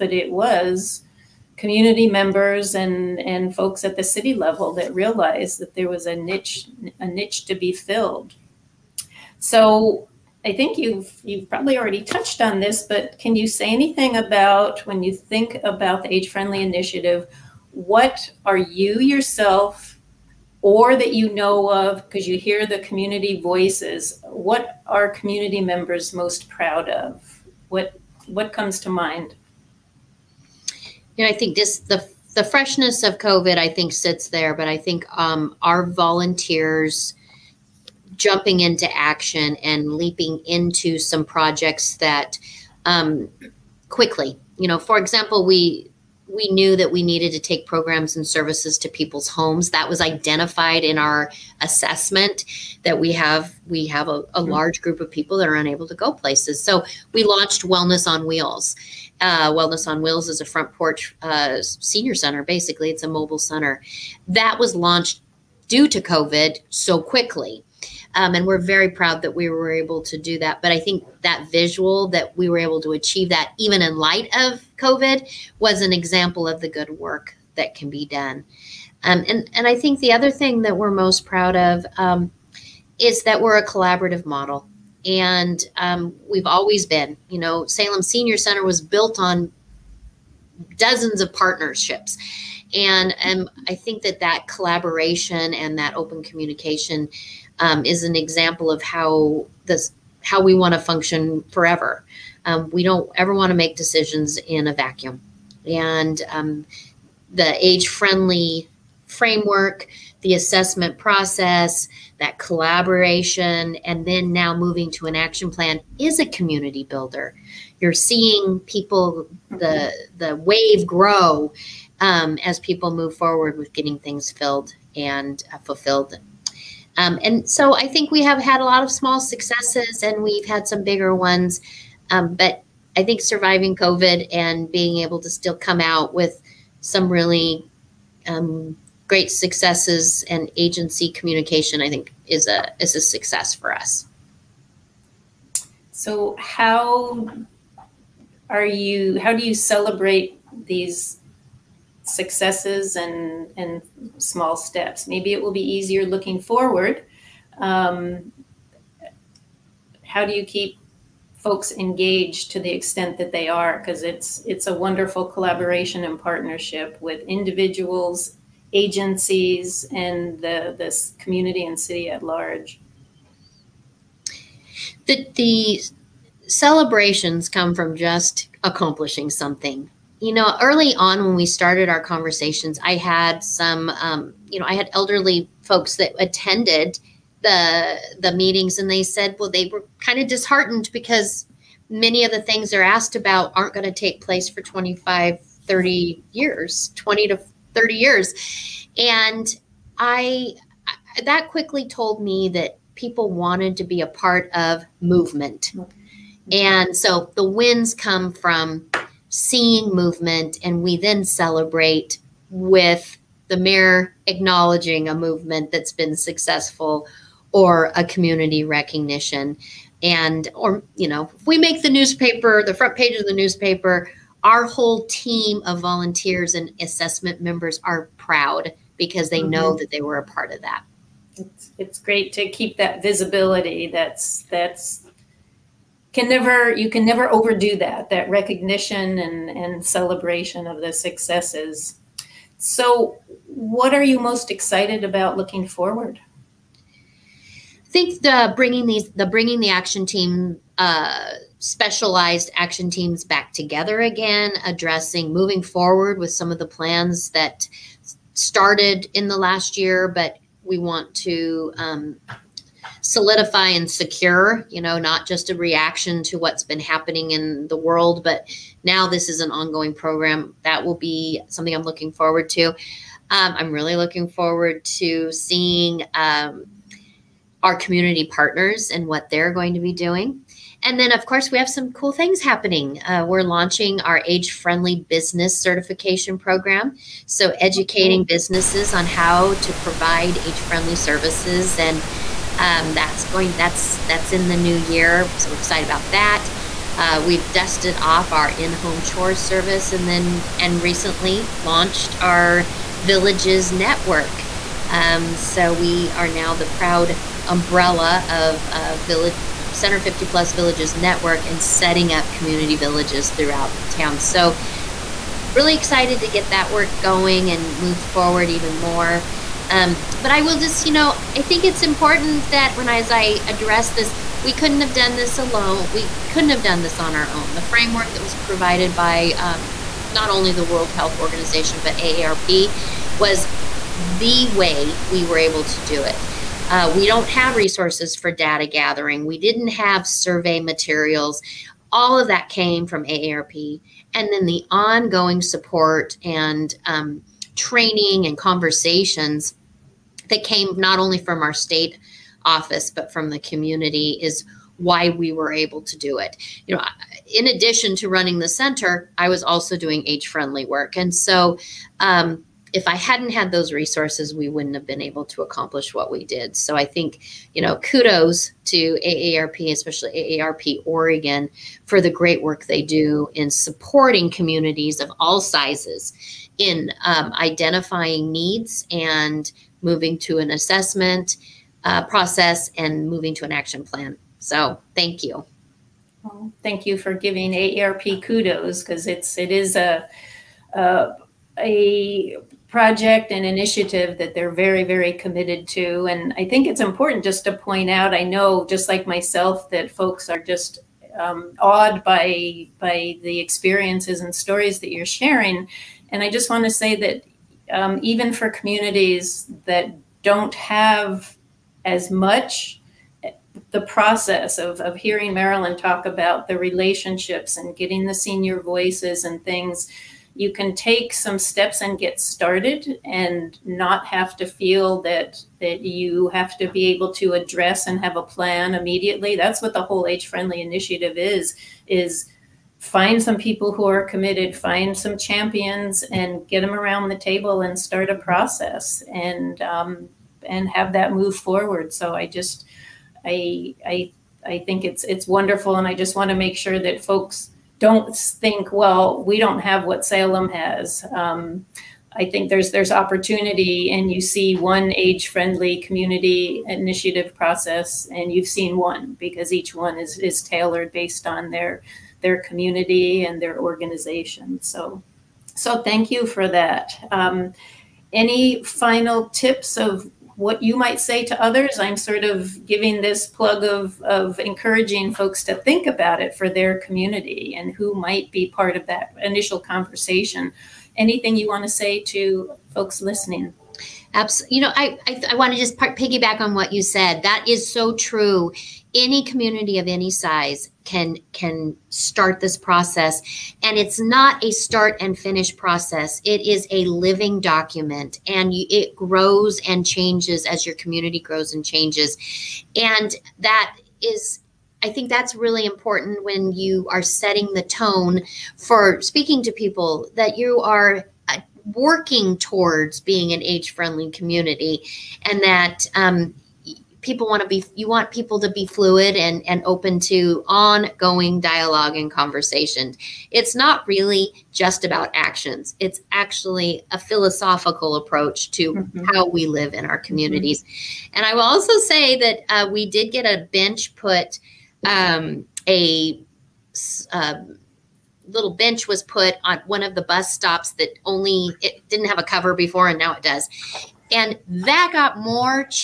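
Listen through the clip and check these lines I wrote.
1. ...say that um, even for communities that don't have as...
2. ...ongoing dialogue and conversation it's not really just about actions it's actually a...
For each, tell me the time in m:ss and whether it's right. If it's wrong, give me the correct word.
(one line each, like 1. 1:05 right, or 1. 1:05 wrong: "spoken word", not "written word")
1. 6:46 right
2. 8:40 right.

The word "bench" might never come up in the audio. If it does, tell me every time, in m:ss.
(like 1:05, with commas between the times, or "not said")
8:53, 8:58.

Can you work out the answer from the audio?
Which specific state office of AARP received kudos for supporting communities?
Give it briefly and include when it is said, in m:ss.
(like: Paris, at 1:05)
AARP Oregon, at 6:10.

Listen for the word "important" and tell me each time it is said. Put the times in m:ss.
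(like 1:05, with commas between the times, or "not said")
5:21, 6:36, 8:25.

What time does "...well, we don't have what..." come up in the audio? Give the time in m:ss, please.
7:28.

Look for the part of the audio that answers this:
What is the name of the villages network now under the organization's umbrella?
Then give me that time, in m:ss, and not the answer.
5:09.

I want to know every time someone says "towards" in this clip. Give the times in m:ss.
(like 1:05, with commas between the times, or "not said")
8:32.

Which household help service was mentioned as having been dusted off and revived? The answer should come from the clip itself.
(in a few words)
in-home chores service.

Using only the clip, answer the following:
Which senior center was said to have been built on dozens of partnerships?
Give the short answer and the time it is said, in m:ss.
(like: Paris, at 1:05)
Salem Senior Center, at 1:27.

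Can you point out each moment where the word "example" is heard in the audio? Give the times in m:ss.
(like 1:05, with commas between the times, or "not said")
0:44, 1:15, 1:38.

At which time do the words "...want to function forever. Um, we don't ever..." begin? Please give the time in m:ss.
1:40.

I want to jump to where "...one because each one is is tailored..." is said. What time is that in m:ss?
7:38.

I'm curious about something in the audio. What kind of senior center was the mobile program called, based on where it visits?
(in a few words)
front porch.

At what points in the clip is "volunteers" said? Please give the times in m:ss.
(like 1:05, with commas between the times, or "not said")
0:35, 3:45.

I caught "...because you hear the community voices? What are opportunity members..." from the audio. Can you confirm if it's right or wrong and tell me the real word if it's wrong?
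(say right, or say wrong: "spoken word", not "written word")
wrong: "community", not "opportunity".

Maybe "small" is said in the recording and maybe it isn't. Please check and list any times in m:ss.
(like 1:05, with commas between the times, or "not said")
2:08, 2:34.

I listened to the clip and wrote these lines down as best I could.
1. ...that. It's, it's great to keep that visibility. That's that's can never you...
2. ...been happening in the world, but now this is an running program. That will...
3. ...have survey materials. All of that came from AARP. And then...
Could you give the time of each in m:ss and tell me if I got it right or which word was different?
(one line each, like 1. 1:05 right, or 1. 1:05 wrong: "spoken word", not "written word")
1. 3:50 right
2. 4:26 wrong: "ongoing", not "running"
3. 5:39 right.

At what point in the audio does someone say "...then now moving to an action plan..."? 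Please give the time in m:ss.
1:54.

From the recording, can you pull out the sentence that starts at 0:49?
That was identified in our assessment that we have we have a, a mm-hmm.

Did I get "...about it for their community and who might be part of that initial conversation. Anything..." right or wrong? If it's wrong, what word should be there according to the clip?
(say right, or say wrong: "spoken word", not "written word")
right.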